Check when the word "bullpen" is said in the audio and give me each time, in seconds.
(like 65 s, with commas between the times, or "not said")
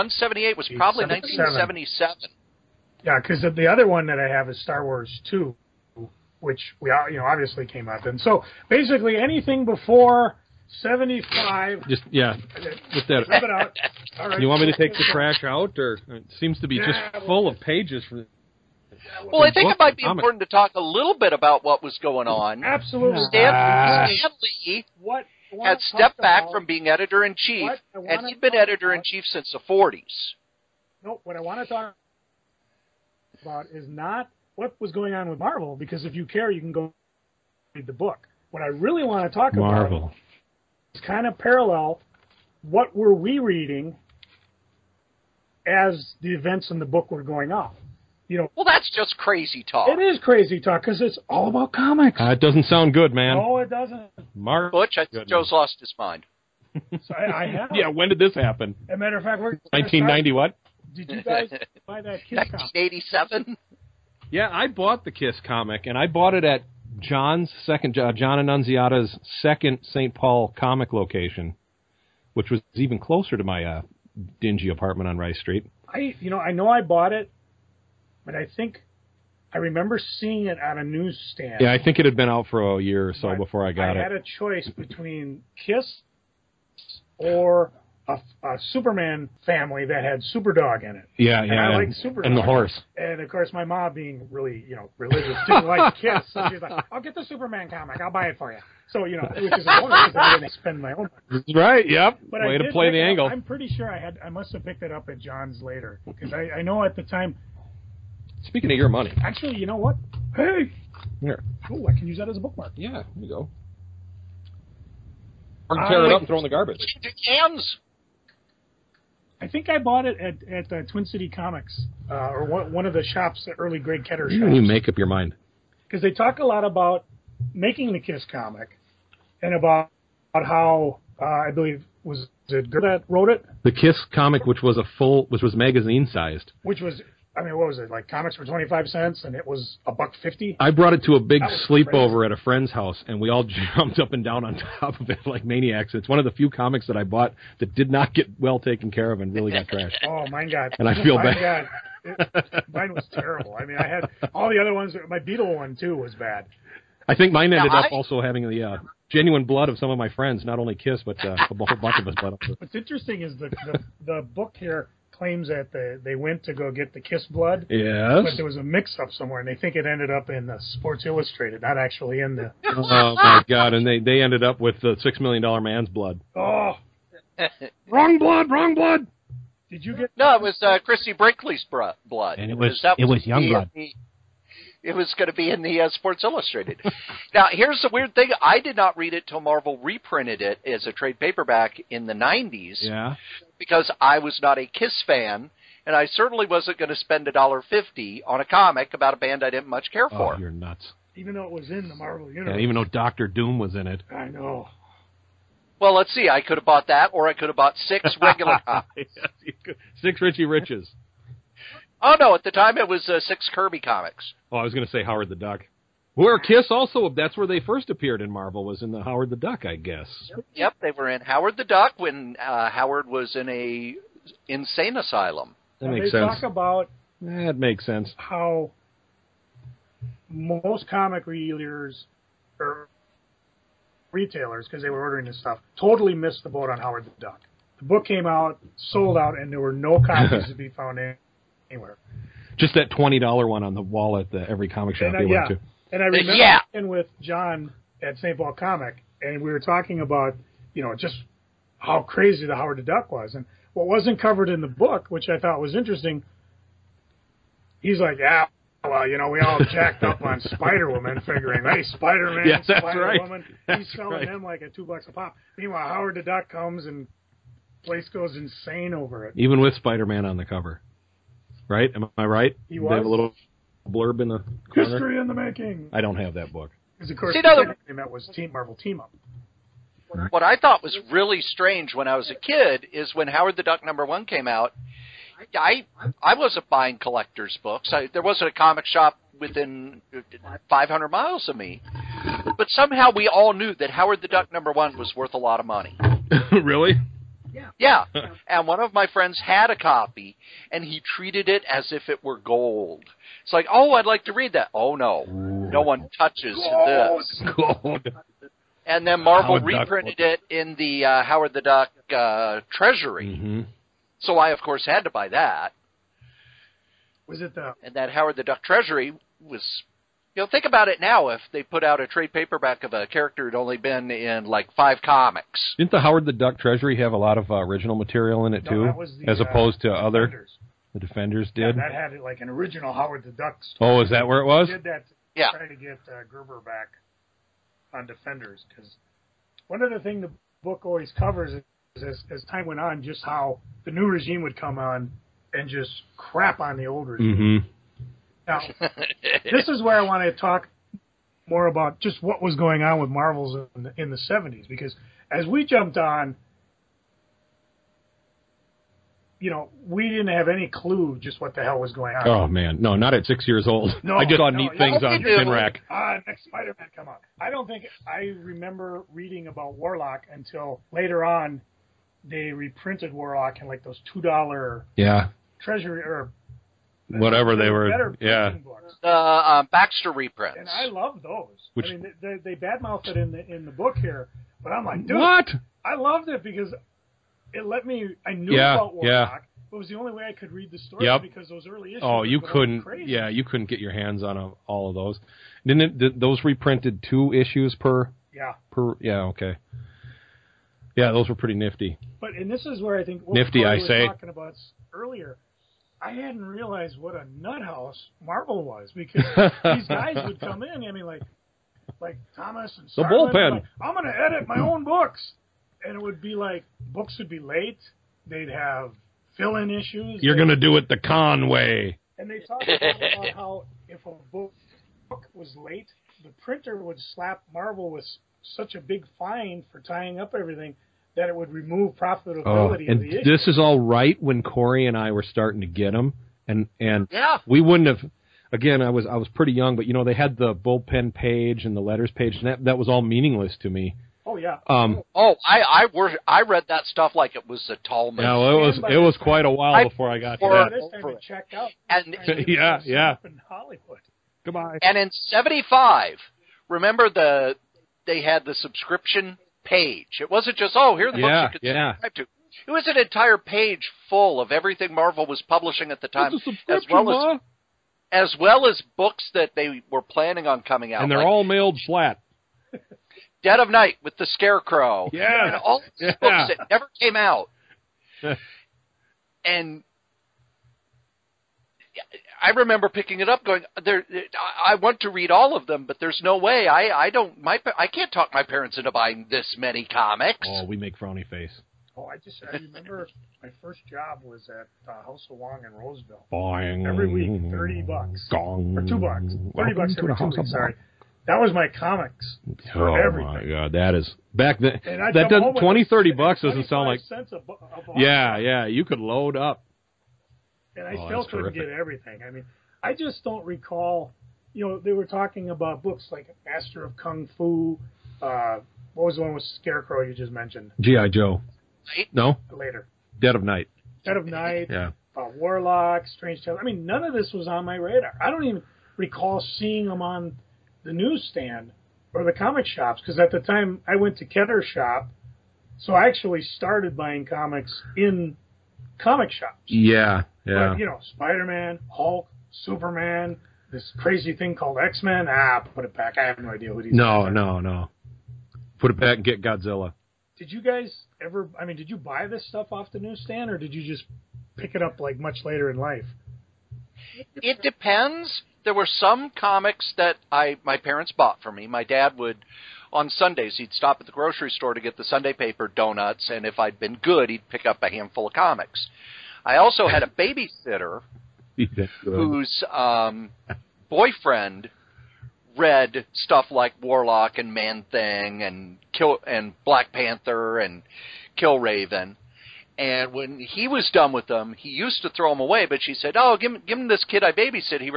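413 s, 440 s.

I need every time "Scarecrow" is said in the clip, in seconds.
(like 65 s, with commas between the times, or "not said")
474 s, 519 s.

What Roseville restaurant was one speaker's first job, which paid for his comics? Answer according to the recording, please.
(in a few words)
House of Wong.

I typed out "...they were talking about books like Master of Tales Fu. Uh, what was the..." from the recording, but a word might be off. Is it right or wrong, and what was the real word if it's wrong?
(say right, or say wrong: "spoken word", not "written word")
wrong: "Kung", not "Tales".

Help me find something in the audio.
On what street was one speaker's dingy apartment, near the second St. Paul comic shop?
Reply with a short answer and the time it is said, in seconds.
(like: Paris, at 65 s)
Rice Street, at 75 s.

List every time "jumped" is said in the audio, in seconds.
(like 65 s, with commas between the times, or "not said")
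143 s, 355 s.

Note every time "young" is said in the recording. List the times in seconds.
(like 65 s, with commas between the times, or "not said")
183 s, 439 s.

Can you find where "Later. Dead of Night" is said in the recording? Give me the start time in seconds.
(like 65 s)
522 s.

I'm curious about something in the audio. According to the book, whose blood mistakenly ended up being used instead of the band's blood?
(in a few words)
the $6 million man's.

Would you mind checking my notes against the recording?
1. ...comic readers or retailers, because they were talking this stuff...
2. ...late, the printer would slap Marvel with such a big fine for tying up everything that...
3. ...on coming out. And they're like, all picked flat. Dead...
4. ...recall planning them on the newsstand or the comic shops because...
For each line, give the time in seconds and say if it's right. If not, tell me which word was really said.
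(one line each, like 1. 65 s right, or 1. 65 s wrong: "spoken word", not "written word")
1. 230 s wrong: "ordering", not "talking"
2. 425 s right
3. 470 s wrong: "mailed", not "picked"
4. 528 s wrong: "seeing", not "planning".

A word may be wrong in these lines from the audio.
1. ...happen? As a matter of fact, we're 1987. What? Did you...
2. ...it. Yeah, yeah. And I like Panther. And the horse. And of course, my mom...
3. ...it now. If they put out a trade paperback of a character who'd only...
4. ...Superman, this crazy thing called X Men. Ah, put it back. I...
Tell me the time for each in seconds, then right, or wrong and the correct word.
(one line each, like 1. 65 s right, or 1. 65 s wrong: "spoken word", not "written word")
1. 58 s wrong: "1990", not "1987"
2. 90 s wrong: "Superdog", not "Panther"
3. 320 s right
4. 542 s right.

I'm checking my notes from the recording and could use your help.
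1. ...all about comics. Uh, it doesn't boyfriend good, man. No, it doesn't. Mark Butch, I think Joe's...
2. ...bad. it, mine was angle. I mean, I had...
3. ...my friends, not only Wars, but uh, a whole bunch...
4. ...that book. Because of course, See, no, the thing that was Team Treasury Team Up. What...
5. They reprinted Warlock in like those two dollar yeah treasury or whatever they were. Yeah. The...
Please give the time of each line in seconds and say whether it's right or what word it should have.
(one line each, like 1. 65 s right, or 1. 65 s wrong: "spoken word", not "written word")
1. 51 s wrong: "sound", not "boyfriend"
2. 151 s wrong: "terrible", not "angle"
3. 159 s wrong: "Kiss", not "Wars"
4. 276 s wrong: "Marvel", not "Treasury"
5. 372 s right.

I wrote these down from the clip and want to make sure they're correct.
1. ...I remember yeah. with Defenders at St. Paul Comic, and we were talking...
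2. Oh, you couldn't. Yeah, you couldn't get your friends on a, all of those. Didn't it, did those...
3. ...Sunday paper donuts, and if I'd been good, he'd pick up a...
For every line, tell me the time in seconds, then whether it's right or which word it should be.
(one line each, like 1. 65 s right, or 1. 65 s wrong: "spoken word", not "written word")
1. 246 s wrong: "John", not "Defenders"
2. 392 s wrong: "hands", not "friends"
3. 565 s right.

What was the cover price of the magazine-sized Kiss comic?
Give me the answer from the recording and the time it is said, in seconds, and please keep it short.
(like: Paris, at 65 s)
a buck fifty, at 139 s.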